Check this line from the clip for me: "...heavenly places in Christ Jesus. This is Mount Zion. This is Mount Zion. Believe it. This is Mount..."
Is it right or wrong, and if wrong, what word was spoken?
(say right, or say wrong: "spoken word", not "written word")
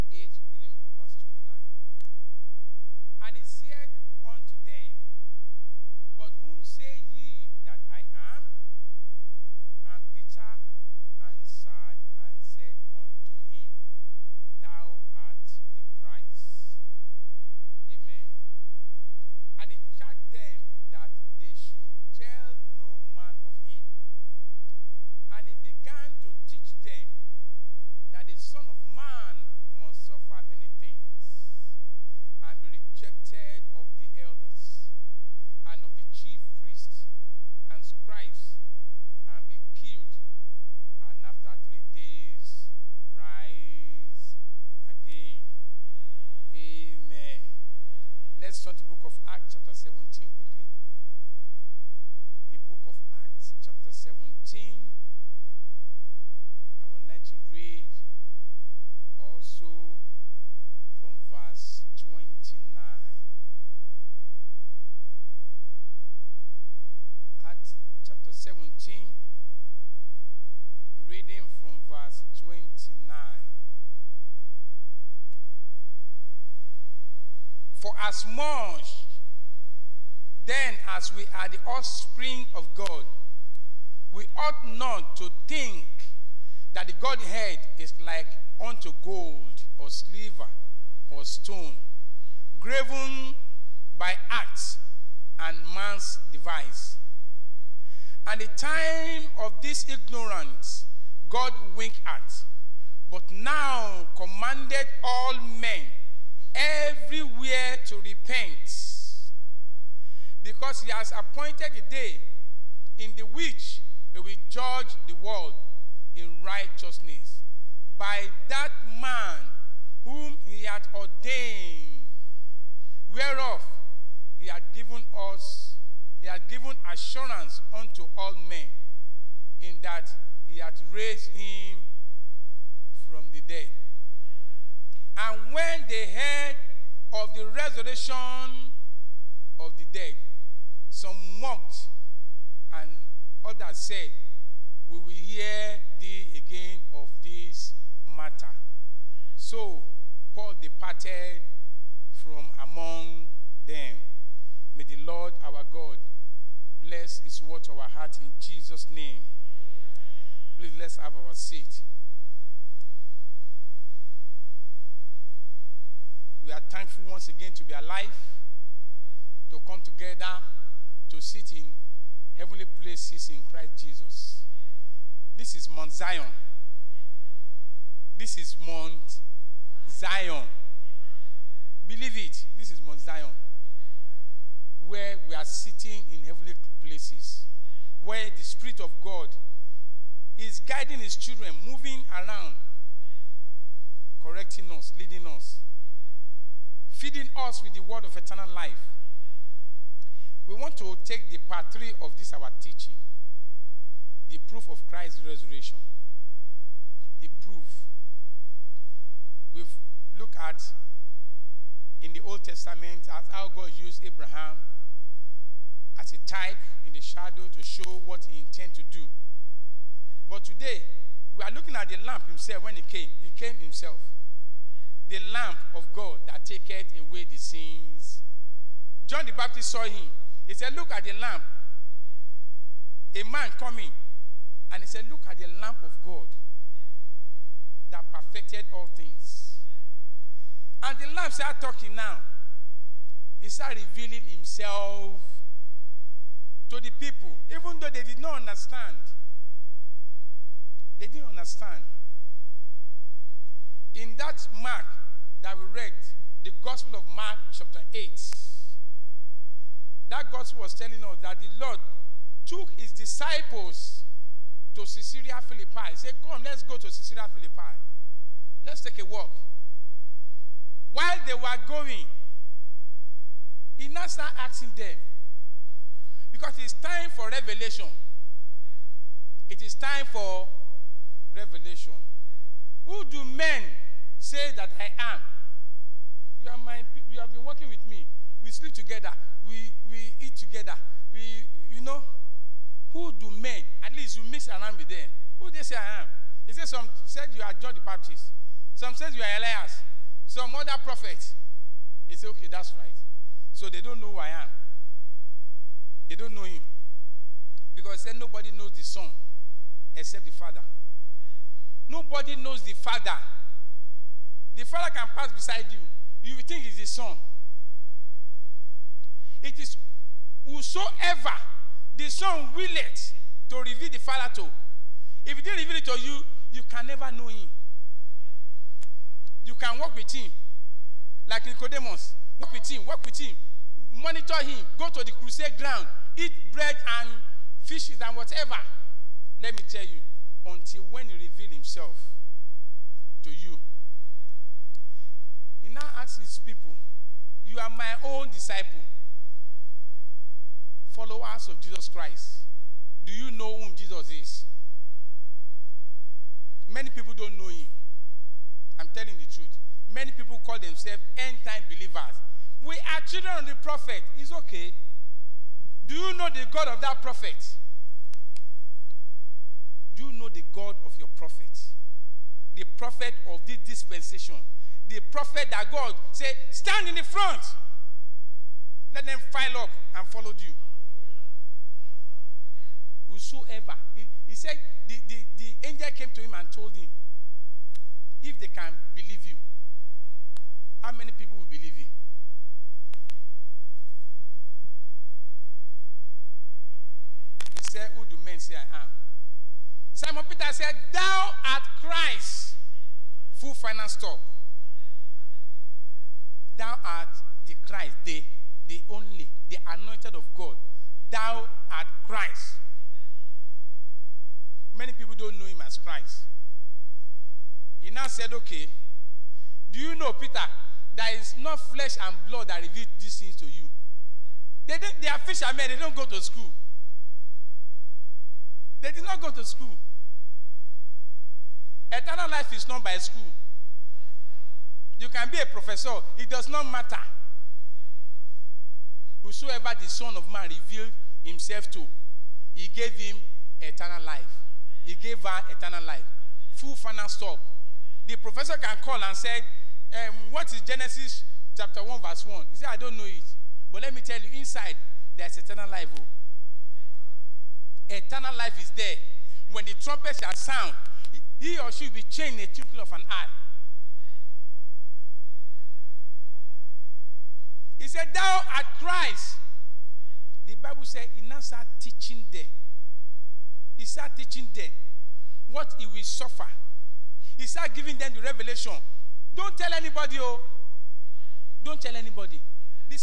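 right.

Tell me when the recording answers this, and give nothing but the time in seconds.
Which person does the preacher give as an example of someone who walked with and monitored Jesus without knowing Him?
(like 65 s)
331 s.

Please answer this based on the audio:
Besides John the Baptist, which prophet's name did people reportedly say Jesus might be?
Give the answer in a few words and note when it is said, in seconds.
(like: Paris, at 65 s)
Elias, at 299 s.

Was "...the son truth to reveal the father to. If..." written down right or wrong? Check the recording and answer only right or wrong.
wrong.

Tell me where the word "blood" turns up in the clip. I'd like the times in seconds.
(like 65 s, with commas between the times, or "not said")
422 s.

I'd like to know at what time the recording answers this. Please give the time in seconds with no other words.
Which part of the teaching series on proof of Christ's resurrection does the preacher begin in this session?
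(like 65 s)
201 s.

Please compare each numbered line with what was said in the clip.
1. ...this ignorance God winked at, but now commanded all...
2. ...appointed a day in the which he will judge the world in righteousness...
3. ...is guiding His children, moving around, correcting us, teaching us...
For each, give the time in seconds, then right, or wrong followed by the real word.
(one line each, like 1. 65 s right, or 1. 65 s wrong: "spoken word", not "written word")
1. 99 s right
2. 111 s right
3. 190 s wrong: "leading", not "teaching".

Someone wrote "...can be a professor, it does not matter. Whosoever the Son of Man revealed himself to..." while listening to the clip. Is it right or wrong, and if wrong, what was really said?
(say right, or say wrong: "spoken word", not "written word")
right.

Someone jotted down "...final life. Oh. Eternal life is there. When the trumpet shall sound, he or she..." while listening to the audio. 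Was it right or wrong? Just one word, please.
wrong.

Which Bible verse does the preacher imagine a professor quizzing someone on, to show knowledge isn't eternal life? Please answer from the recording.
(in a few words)
Genesis 1:1.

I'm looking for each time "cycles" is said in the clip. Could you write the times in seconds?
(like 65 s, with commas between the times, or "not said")
not said.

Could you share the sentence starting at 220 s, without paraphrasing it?
But today, we are looking at the lamb himself when he came.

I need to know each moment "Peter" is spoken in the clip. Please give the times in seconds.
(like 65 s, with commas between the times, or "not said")
400 s, 420 s.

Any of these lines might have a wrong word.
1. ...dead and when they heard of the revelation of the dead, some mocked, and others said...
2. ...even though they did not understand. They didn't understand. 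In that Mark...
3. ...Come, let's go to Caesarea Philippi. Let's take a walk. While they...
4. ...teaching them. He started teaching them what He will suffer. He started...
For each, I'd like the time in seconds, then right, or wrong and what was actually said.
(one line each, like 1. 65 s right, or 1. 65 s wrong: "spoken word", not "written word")
1. 133 s wrong: "resurrection", not "revelation"
2. 247 s right
3. 266 s right
4. 471 s right.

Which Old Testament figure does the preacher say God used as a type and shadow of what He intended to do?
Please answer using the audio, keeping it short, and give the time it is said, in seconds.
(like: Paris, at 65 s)
Abraham, at 214 s.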